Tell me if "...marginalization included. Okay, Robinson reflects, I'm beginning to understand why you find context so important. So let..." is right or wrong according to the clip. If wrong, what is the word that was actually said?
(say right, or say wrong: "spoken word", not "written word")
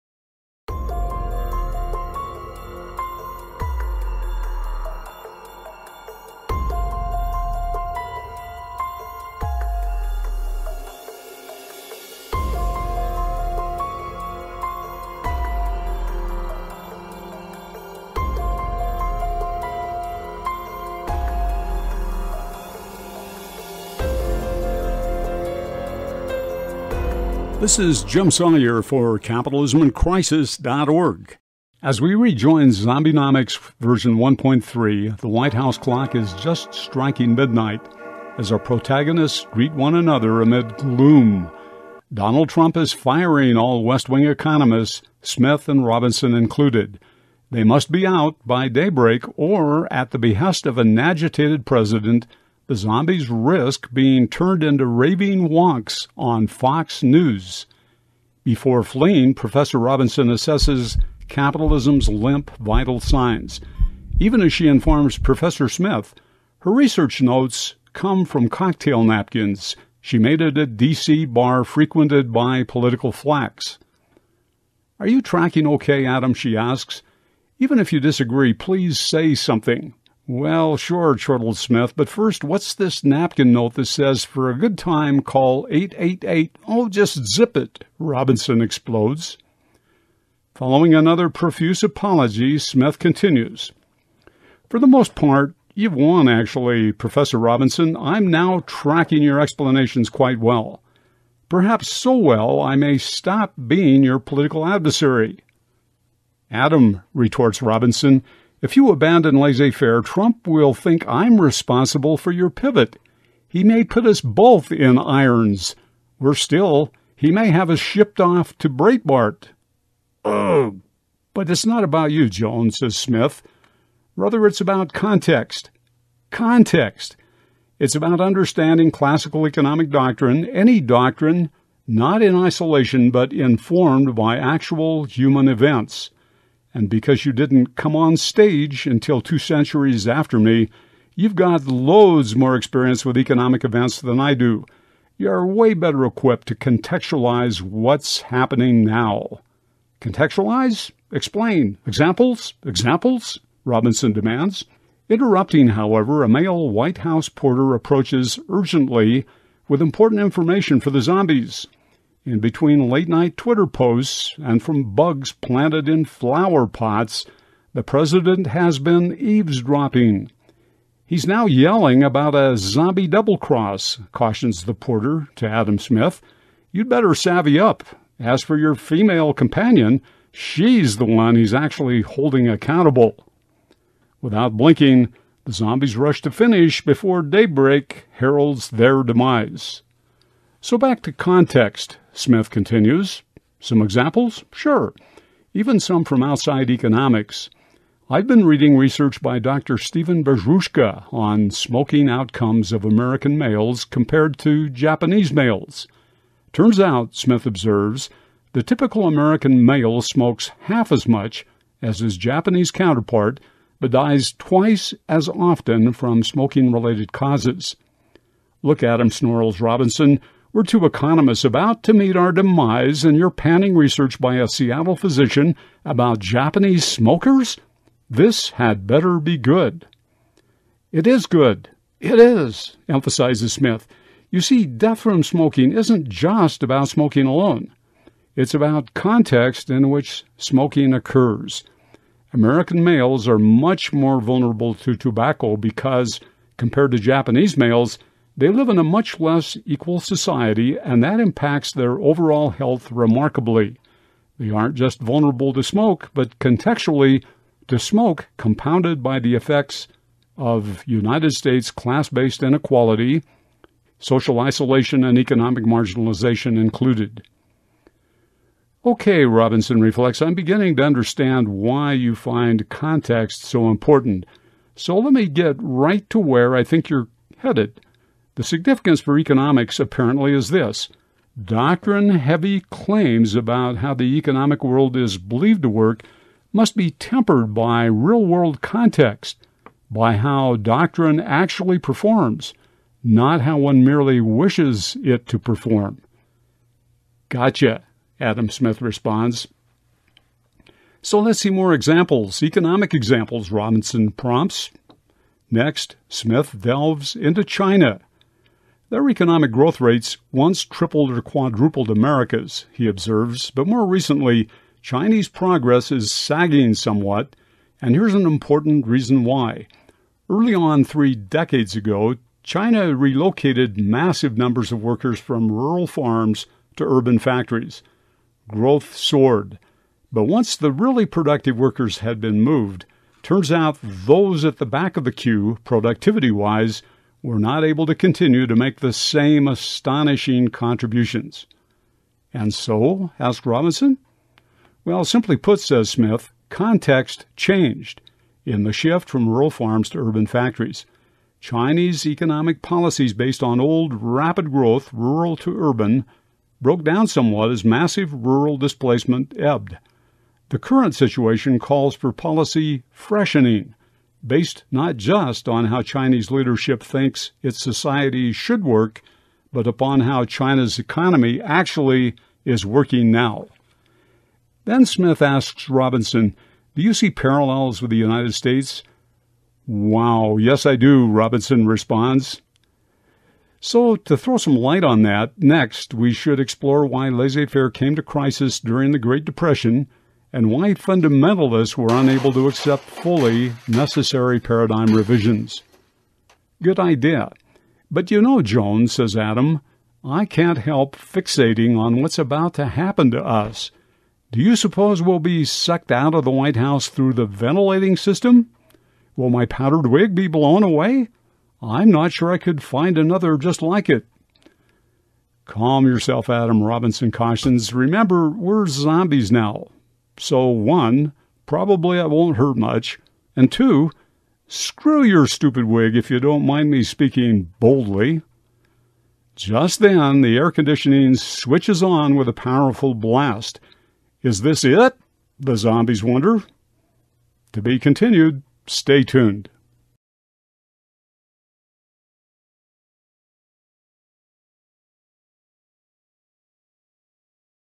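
right.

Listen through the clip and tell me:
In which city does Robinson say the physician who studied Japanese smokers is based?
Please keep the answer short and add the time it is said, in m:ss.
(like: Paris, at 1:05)
Seattle, at 3:44.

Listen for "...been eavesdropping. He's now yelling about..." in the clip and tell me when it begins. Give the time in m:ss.
2:48.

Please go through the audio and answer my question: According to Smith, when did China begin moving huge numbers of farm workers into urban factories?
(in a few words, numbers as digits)
Three decades ago.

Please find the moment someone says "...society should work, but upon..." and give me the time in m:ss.
6:07.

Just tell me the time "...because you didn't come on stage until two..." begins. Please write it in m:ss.
2:16.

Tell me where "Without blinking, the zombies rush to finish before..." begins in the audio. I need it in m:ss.
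3:04.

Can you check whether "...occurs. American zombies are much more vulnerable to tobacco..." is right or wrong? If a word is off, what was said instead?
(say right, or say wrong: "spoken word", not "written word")
wrong: "males", not "zombies".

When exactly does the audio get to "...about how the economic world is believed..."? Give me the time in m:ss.
4:43.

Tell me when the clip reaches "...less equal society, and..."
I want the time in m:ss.
4:09.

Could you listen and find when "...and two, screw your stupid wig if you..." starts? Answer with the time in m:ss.
7:03.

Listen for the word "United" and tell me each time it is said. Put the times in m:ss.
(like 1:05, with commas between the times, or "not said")
4:20, 6:17.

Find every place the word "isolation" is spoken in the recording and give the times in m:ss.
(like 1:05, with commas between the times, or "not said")
2:12, 4:24.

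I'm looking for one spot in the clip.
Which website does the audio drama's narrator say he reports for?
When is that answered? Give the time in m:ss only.
0:29.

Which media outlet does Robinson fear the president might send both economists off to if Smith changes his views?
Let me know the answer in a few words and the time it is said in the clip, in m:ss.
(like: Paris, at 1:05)
Breitbart, at 1:58.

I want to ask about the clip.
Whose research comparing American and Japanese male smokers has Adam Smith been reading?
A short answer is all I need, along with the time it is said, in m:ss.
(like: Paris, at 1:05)
Dr. Stephen Bezruchka, at 3:19.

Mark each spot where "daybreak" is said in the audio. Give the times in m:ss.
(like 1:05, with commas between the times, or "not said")
0:48, 3:07.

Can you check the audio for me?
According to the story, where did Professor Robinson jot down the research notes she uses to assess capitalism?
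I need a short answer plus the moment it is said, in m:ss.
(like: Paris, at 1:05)
Cocktail napkins, at 1:08.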